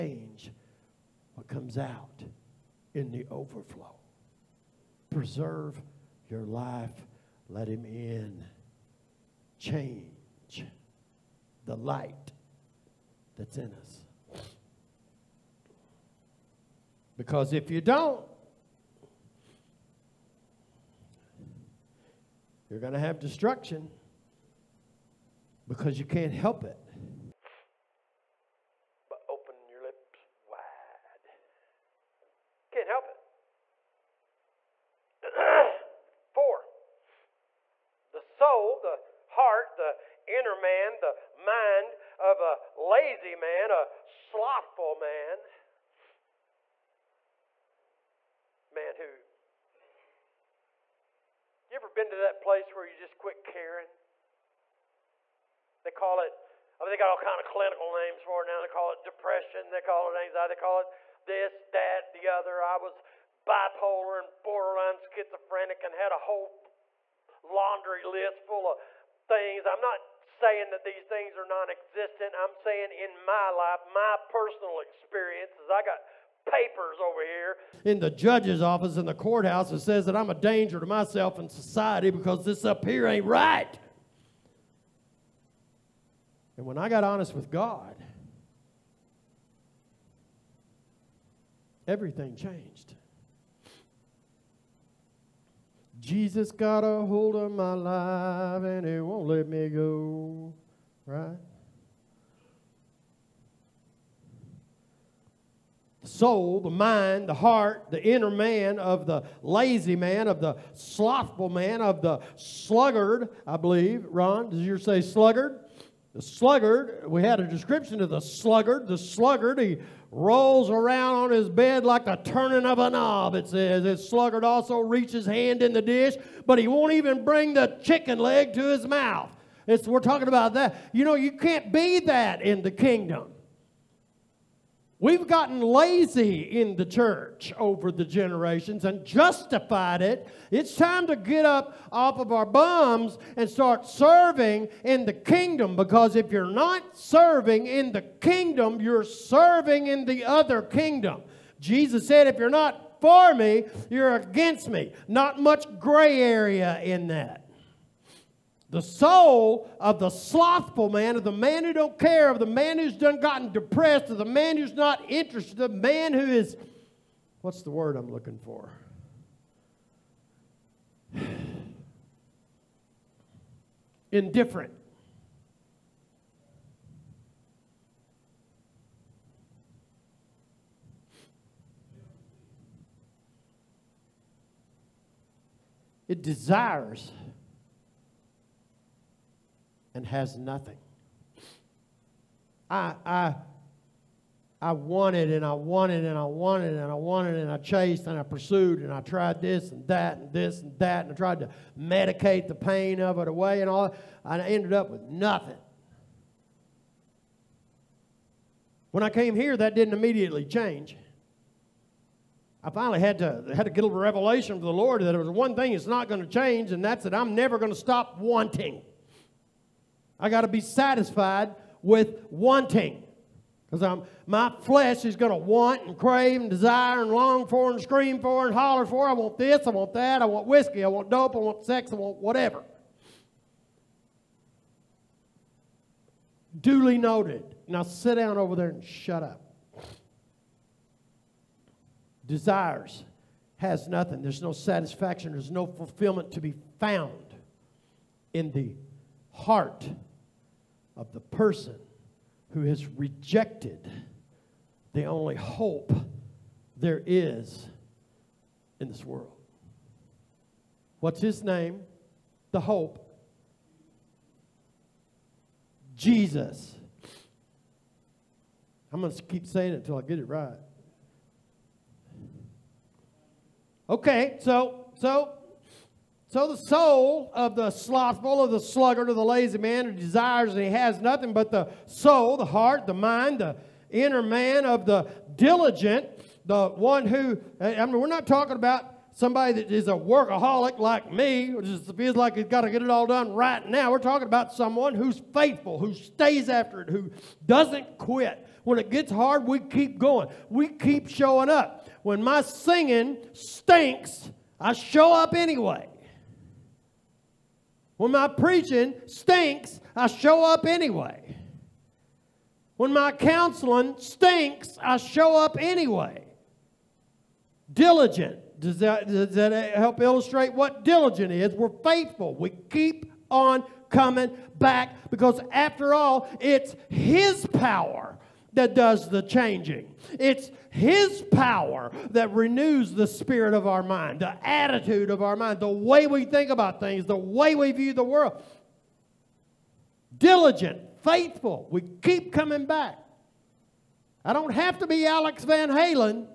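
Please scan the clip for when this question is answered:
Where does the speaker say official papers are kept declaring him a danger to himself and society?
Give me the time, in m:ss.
1:19.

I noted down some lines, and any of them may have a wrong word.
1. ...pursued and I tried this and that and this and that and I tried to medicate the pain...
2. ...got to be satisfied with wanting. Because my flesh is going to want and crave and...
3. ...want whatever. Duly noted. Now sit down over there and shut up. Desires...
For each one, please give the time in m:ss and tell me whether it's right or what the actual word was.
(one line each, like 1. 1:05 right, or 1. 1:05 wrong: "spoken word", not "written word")
1. 3:18 right
2. 3:40 right
3. 3:51 right.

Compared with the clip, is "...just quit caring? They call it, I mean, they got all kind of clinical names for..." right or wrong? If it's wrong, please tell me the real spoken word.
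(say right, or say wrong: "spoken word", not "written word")
right.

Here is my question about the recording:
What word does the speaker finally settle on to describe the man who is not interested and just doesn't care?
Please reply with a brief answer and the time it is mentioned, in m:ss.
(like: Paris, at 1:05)
Indifferent, at 2:54.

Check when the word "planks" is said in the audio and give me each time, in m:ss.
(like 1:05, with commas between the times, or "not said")
not said.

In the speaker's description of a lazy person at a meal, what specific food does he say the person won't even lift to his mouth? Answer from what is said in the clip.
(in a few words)
chicken leg.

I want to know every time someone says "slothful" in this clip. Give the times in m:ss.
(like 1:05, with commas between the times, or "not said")
0:44, 1:50, 2:40, 4:37.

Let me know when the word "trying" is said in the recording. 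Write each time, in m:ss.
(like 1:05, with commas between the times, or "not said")
not said.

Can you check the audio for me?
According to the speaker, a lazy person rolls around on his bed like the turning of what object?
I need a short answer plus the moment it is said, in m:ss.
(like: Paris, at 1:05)
a knob, at 2:02.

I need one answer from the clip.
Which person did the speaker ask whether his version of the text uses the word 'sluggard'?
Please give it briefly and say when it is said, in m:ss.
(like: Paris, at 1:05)
Ron, at 1:54.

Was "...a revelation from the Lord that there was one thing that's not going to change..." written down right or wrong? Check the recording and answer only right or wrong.
right.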